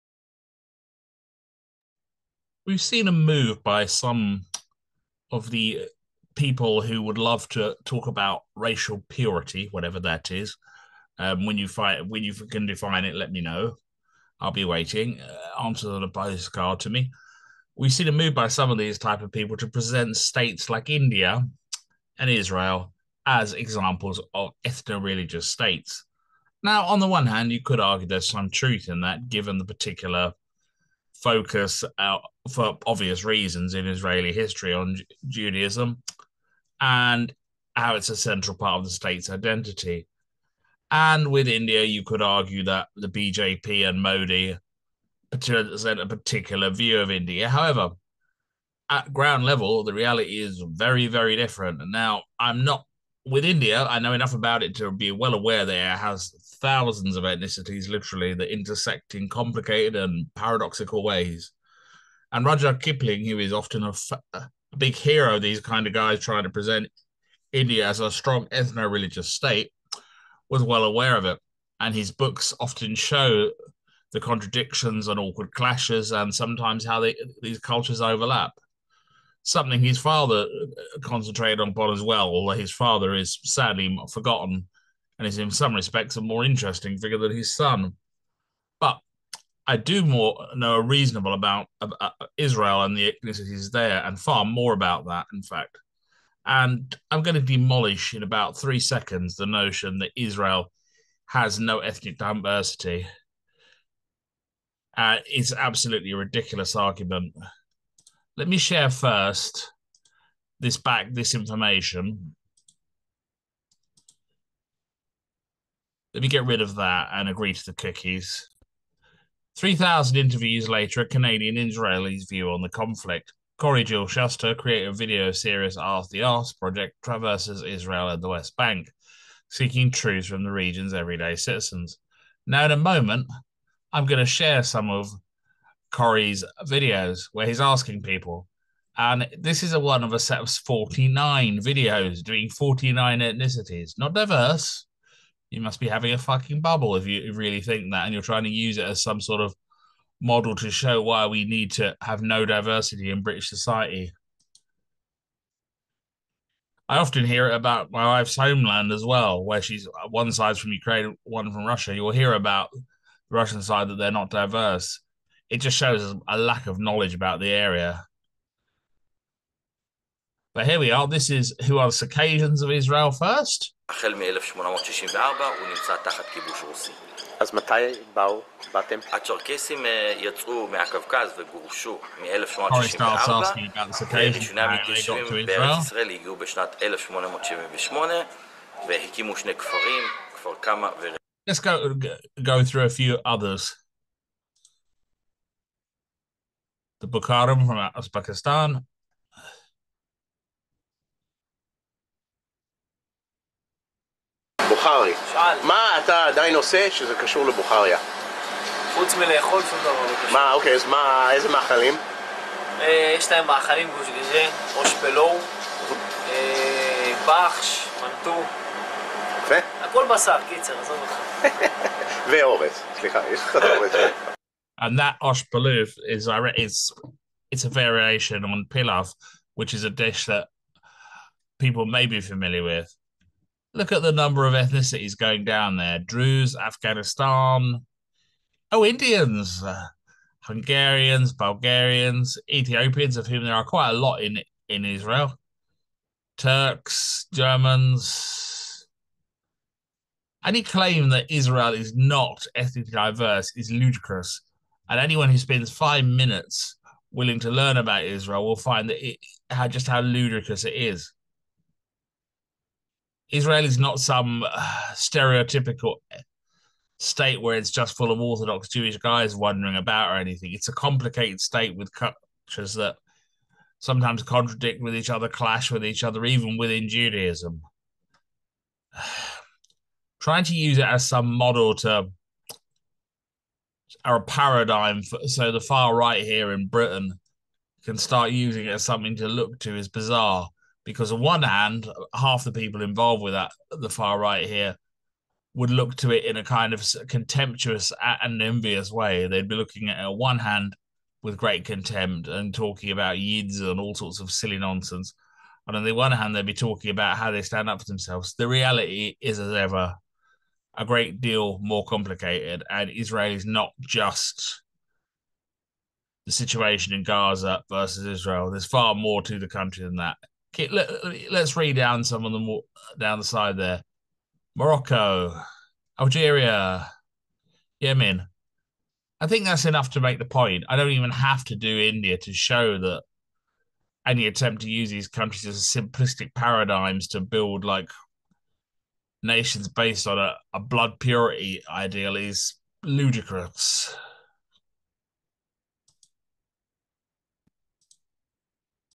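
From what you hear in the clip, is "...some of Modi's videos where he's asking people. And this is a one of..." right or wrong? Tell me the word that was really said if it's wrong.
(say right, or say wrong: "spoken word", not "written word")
wrong: "Corey", not "Modi".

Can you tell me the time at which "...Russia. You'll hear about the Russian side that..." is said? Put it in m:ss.
2:41.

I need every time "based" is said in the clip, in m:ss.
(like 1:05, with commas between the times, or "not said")
5:39.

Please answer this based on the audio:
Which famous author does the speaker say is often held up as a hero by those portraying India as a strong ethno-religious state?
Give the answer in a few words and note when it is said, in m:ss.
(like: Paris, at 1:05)
Rudyard Kipling, at 1:02.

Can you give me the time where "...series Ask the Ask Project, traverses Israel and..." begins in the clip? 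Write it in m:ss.
2:05.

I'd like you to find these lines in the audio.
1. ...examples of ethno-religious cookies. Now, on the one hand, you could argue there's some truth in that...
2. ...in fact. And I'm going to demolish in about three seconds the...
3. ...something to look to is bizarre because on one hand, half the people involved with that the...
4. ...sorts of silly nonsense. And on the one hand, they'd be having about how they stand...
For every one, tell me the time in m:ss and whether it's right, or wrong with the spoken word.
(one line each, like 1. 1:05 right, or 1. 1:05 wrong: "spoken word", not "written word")
1. 0:23 wrong: "states", not "cookies"
2. 1:35 right
3. 4:48 right
4. 5:03 wrong: "talking", not "having".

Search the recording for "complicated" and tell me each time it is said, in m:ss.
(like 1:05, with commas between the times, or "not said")
0:59, 4:30, 5:11.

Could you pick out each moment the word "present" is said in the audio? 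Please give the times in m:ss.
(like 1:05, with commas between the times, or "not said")
0:19, 0:45, 1:06.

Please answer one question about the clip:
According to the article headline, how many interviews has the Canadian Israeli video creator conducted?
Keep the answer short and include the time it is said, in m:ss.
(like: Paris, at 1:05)
3,000, at 1:59.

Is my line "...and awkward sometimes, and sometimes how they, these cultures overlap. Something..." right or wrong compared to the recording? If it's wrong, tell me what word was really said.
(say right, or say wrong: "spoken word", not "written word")
wrong: "clashes", not "sometimes".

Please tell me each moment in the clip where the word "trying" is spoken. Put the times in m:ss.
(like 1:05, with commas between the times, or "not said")
1:06, 2:28, 4:40.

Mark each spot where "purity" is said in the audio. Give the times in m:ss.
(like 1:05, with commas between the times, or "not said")
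0:09, 5:40.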